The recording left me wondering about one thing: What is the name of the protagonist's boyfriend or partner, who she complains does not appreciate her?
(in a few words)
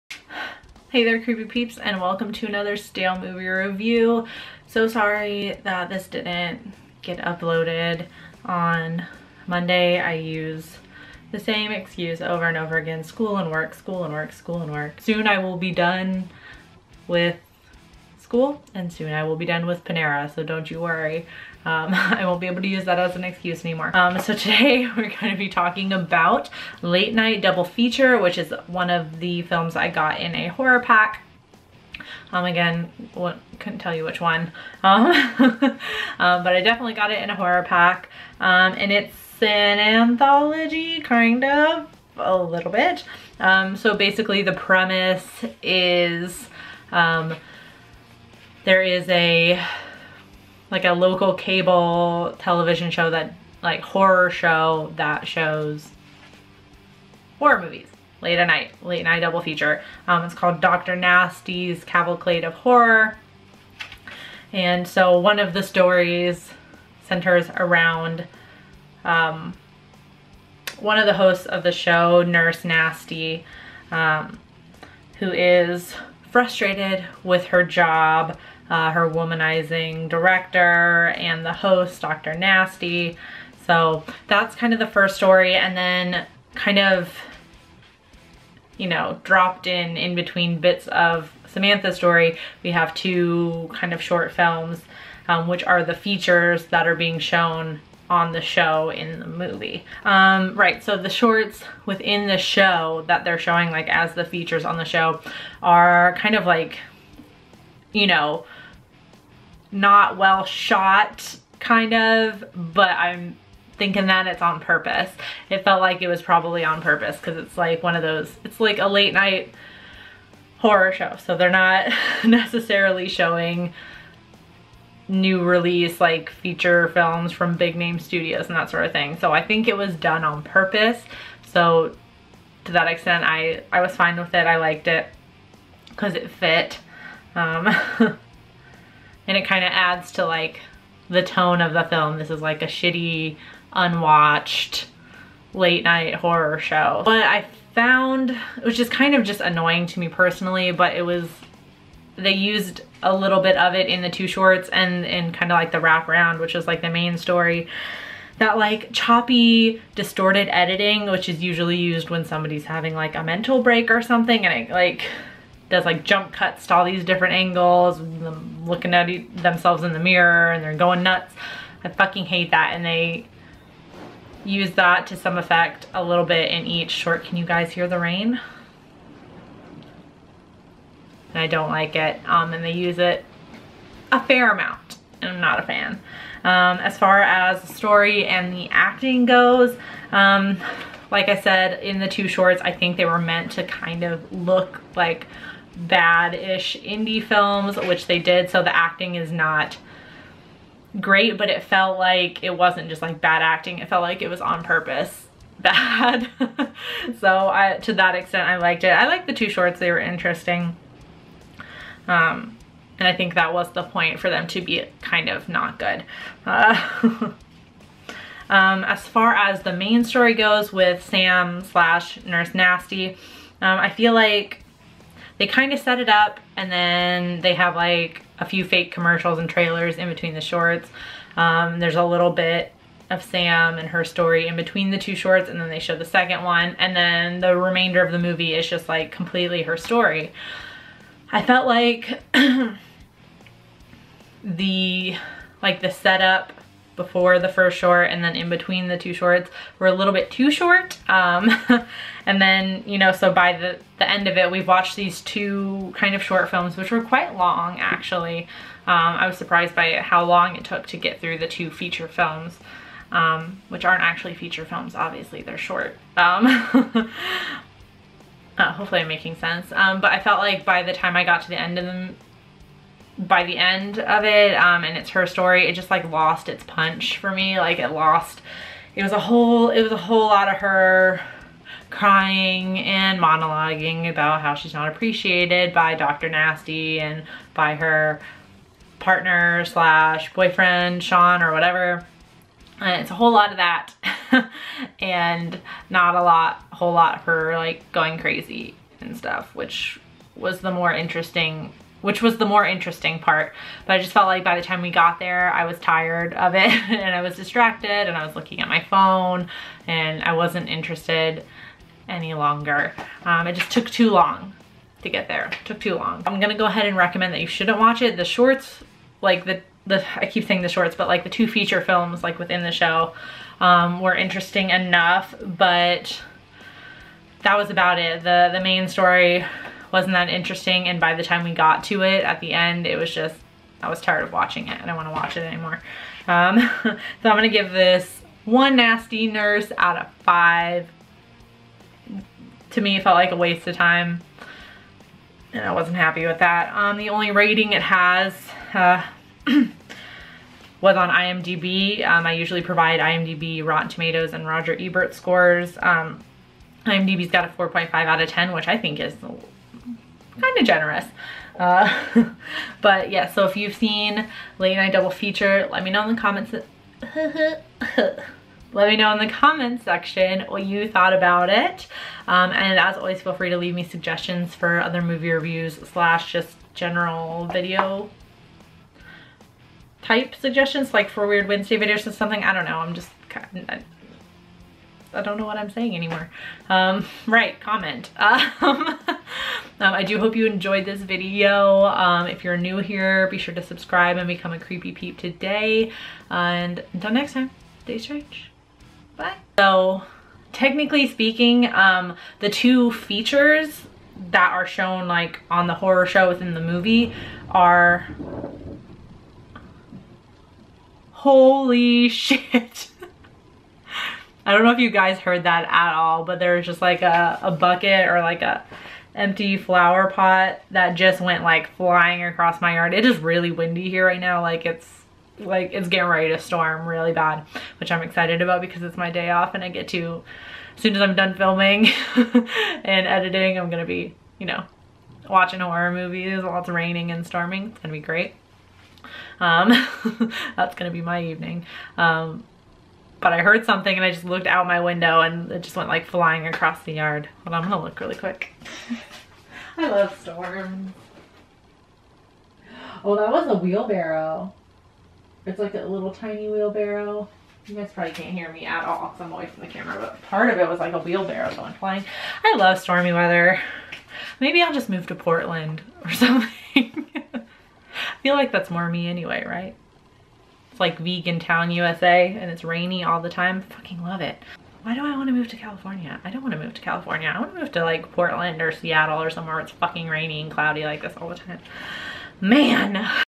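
Sean.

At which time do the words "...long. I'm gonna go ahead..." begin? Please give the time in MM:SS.
05:15.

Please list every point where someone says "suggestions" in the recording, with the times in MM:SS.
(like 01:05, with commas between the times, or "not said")
06:13, 06:20.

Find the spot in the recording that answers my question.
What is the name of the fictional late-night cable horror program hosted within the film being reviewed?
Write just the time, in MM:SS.
01:00.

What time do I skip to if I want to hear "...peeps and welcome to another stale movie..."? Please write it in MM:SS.
00:01.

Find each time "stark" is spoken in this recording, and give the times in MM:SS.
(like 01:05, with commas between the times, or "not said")
not said.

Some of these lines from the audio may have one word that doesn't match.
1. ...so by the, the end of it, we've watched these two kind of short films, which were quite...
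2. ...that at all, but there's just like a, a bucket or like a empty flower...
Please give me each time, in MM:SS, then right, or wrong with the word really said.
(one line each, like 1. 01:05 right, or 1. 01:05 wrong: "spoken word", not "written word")
1. 04:13 right
2. 06:55 right.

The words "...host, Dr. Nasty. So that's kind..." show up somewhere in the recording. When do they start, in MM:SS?
01:21.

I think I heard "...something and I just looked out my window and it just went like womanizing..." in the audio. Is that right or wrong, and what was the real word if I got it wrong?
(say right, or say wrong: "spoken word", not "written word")
wrong: "flying", not "womanizing".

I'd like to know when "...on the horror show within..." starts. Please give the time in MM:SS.
06:45.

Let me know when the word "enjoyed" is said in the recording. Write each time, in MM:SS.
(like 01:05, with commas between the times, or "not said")
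06:30.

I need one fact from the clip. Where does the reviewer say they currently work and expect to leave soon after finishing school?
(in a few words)
Panera.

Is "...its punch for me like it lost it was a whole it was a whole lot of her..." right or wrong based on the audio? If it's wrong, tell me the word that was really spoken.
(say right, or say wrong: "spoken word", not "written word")
right.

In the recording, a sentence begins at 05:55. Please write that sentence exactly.
Um, IMDb's got a 4.5 out of 10, which I think is kind of generous.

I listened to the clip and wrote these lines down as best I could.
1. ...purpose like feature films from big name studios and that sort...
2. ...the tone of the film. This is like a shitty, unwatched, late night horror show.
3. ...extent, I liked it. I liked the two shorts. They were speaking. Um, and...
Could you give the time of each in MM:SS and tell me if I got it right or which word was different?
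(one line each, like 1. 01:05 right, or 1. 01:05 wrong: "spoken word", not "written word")
1. 02:05 wrong: "release", not "purpose"
2. 02:21 right
3. 03:28 wrong: "interesting", not "speaking".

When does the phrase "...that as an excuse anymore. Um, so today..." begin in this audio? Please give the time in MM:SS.
00:22.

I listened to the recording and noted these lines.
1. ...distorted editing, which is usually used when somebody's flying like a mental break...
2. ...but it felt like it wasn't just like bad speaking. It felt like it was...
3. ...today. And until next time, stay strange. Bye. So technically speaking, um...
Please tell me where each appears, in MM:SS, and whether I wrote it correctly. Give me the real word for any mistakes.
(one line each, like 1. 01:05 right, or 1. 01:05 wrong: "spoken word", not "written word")
1. 02:39 wrong: "having", not "flying"
2. 03:21 wrong: "acting", not "speaking"
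3. 06:35 right.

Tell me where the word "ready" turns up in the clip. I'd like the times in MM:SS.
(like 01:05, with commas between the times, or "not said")
07:06.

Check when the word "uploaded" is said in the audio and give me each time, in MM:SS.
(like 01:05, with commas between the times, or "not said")
00:07.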